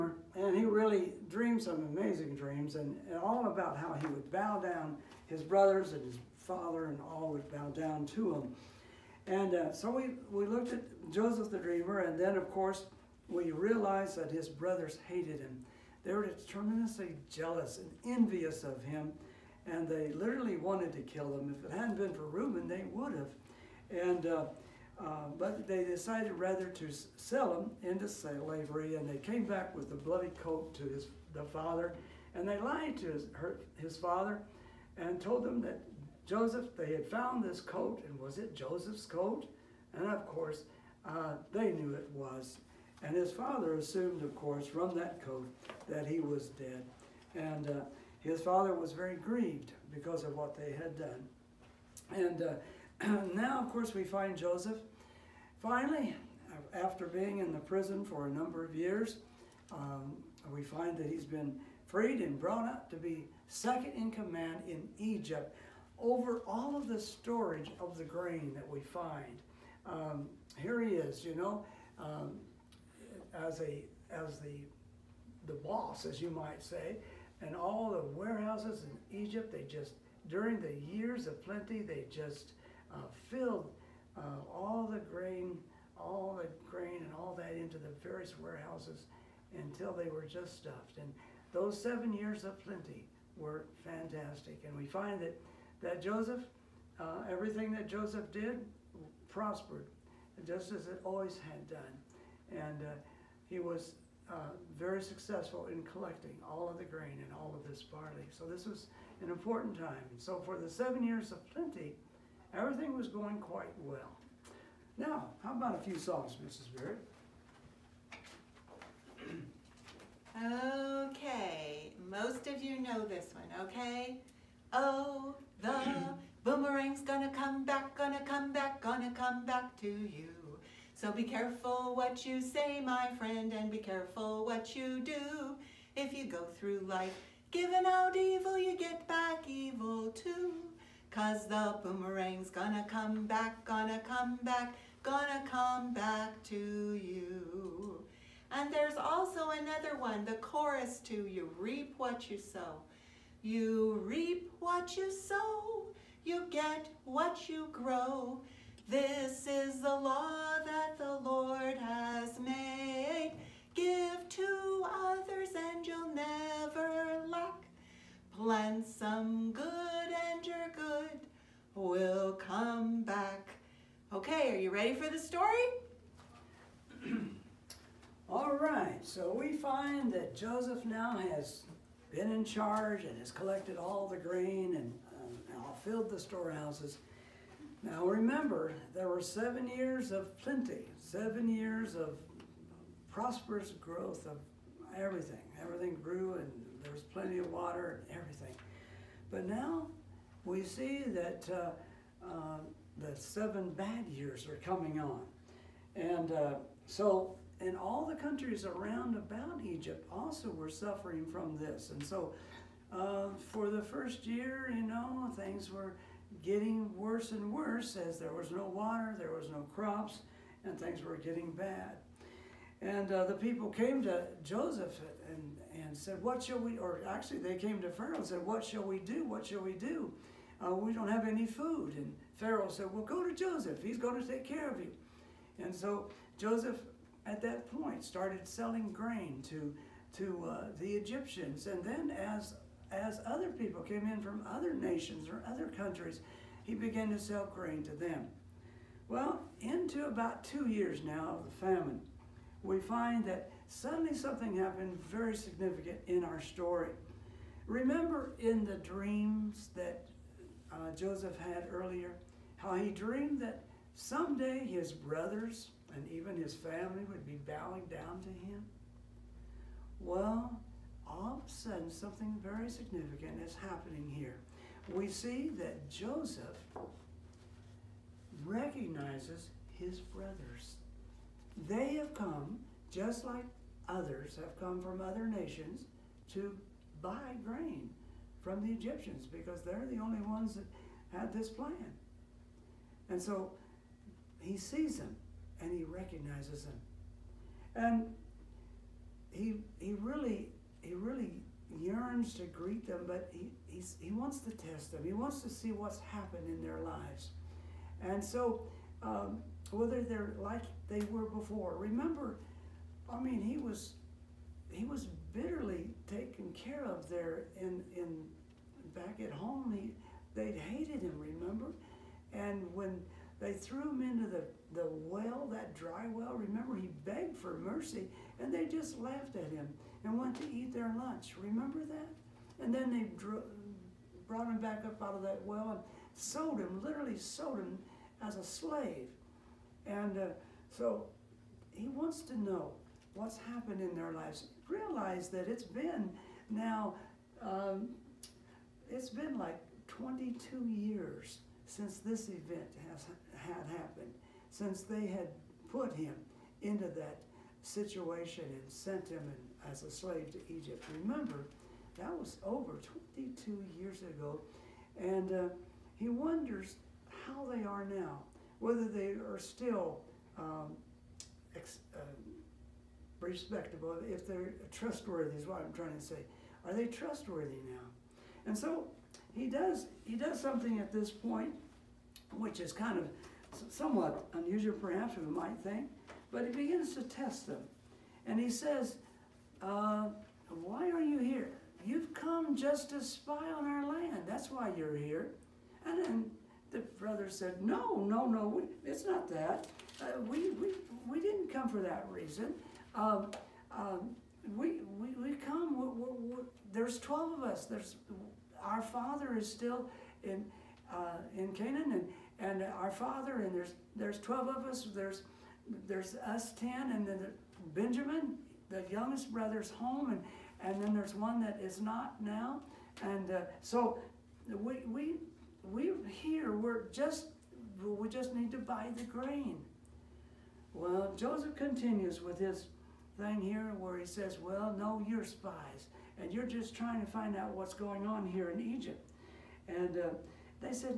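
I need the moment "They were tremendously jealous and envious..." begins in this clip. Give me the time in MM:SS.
00:16.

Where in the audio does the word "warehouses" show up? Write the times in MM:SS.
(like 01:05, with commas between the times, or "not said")
01:18, 01:28.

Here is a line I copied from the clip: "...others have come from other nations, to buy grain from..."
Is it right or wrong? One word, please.
right.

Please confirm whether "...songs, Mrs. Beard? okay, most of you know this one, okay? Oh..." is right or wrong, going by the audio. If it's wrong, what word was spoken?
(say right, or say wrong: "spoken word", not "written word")
right.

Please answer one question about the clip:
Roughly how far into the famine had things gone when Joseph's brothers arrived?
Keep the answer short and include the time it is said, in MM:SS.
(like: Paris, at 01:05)
About 2 years, at 04:10.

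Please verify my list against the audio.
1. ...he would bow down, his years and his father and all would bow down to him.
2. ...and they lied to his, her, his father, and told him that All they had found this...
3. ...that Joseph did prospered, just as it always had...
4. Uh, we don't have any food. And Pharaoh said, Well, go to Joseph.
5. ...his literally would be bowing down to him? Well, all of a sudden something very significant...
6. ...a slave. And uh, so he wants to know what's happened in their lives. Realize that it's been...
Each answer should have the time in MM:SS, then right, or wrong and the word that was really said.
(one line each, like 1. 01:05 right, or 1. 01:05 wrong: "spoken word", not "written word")
1. 00:04 wrong: "brothers", not "years"
2. 00:32 wrong: "Joseph", not "All"
3. 01:37 right
4. 03:50 right
5. 04:26 wrong: "family", not "literally"
6. 05:38 right.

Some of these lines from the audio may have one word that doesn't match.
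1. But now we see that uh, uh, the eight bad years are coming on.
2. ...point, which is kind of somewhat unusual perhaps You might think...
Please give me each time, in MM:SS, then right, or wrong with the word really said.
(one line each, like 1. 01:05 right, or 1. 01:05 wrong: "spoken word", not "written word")
1. 03:19 wrong: "seven", not "eight"
2. 06:21 right.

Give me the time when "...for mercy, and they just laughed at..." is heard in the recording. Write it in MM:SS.
05:27.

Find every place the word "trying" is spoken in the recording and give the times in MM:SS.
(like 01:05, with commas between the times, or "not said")
06:15, 07:16.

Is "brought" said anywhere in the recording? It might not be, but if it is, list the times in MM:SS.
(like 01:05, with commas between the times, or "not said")
01:02, 05:34.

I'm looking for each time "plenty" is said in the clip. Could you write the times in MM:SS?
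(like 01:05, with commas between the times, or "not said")
01:21, 01:32, 01:51, 03:10, 03:17.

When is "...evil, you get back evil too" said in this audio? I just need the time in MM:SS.
02:18.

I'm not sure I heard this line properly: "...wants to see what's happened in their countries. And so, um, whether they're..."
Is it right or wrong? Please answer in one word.
wrong.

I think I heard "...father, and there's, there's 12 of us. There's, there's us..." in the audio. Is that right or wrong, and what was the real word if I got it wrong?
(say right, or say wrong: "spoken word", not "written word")
right.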